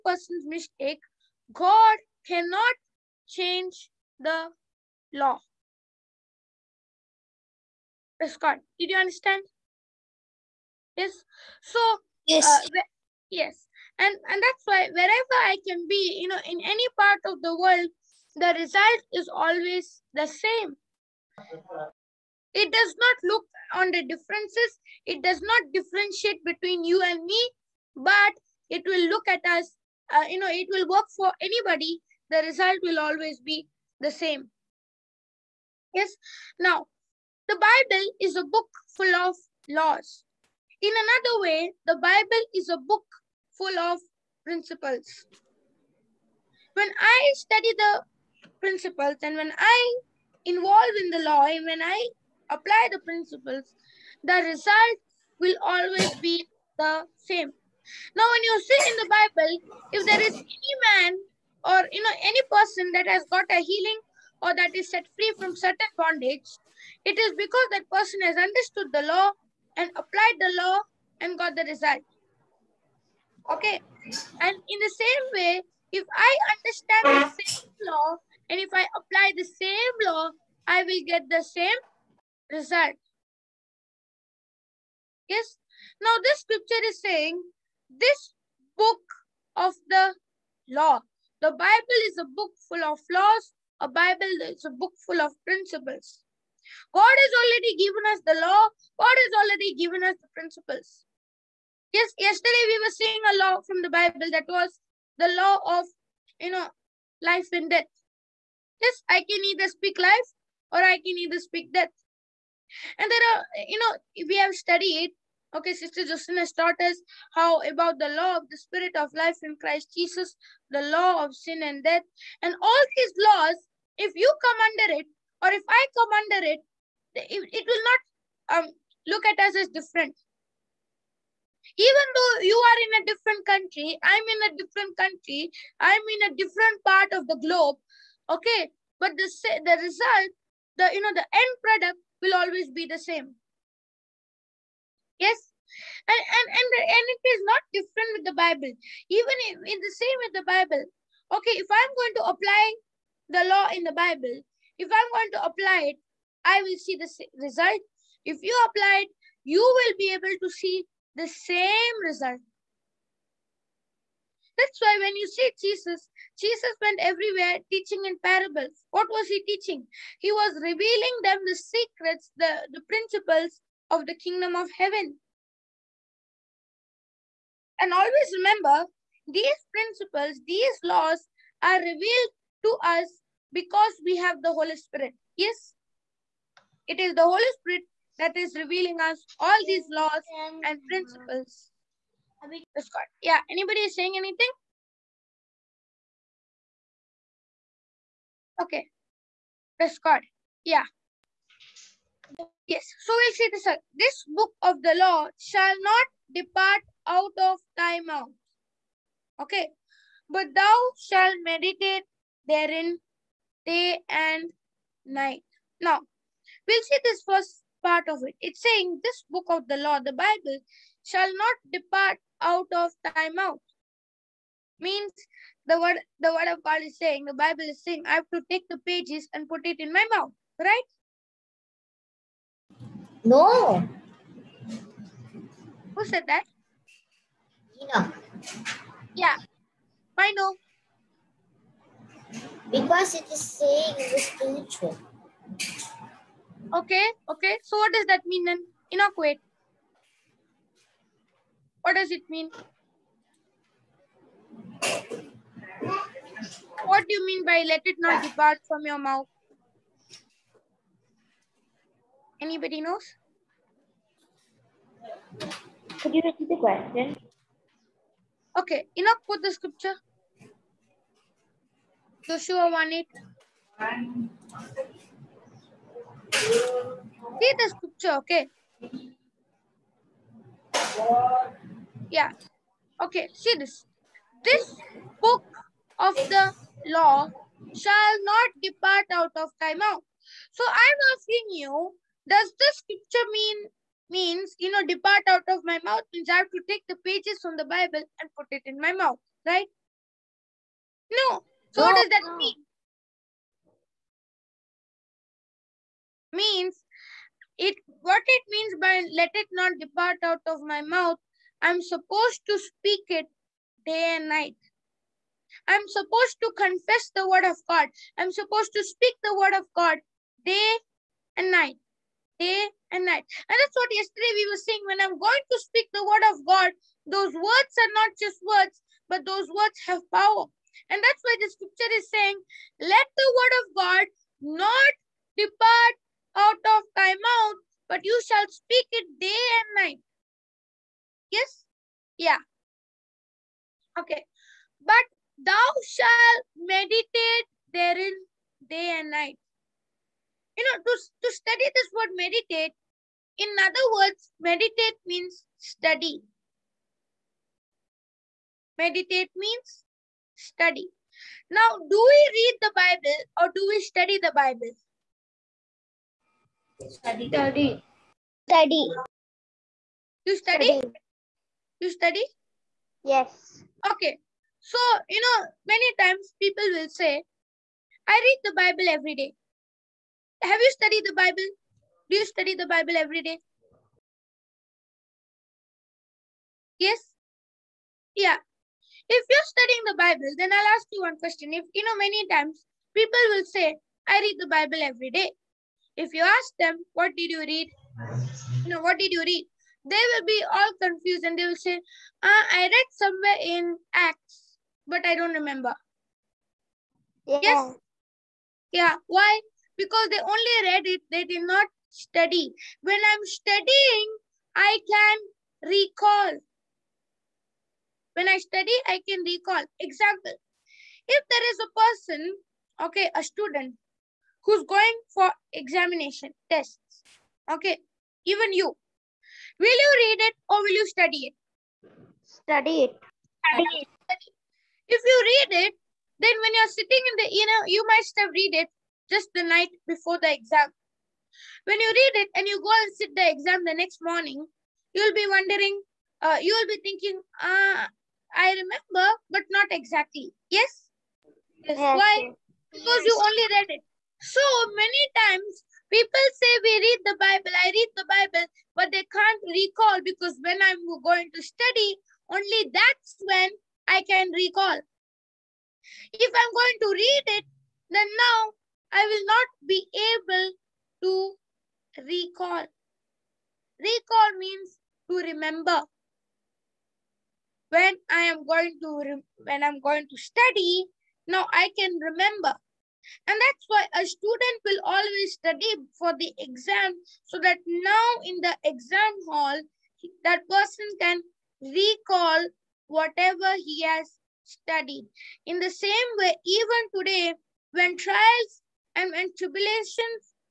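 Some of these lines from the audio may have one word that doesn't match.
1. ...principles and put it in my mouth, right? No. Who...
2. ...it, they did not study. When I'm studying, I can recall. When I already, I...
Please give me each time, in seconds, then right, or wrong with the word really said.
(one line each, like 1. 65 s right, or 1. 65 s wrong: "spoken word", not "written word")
1. 228 s wrong: "pages", not "principles"
2. 410 s wrong: "study", not "already".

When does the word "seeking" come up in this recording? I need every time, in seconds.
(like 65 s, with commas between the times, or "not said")
not said.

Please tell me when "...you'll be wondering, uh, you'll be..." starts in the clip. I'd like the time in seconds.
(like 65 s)
444 s.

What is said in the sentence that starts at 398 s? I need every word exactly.
You know, what did you read?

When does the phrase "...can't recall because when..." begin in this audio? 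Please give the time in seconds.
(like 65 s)
459 s.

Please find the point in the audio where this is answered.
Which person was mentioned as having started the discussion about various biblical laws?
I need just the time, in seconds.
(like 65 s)
115 s.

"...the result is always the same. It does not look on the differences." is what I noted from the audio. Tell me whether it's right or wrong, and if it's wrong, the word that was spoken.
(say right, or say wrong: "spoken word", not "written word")
right.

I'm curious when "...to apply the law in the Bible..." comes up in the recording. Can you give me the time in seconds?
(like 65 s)
152 s.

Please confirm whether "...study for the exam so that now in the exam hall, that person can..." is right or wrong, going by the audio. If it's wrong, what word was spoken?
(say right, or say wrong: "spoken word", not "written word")
right.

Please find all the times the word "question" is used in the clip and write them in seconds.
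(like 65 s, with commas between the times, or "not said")
266 s, 391 s.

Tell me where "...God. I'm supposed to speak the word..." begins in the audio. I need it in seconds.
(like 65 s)
317 s.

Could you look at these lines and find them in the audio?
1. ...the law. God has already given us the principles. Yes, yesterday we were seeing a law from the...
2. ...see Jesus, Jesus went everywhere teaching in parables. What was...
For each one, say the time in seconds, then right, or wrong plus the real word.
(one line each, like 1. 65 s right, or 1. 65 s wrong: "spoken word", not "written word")
1. 98 s right
2. 165 s right.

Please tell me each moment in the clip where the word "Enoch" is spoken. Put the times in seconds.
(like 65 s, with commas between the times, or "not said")
237 s, 248 s, 268 s.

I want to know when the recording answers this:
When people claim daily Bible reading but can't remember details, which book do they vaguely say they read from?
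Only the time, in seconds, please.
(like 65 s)
403 s.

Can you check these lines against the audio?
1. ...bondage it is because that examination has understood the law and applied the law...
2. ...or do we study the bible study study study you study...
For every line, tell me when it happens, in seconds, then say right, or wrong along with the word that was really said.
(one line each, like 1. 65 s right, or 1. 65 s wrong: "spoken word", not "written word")
1. 65 s wrong: "person", not "examination"
2. 363 s right.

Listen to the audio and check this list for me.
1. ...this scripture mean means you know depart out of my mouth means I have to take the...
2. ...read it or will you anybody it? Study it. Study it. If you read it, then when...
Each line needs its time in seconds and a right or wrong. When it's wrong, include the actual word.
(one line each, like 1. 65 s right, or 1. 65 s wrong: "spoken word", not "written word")
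1. 292 s right
2. 430 s wrong: "study", not "anybody".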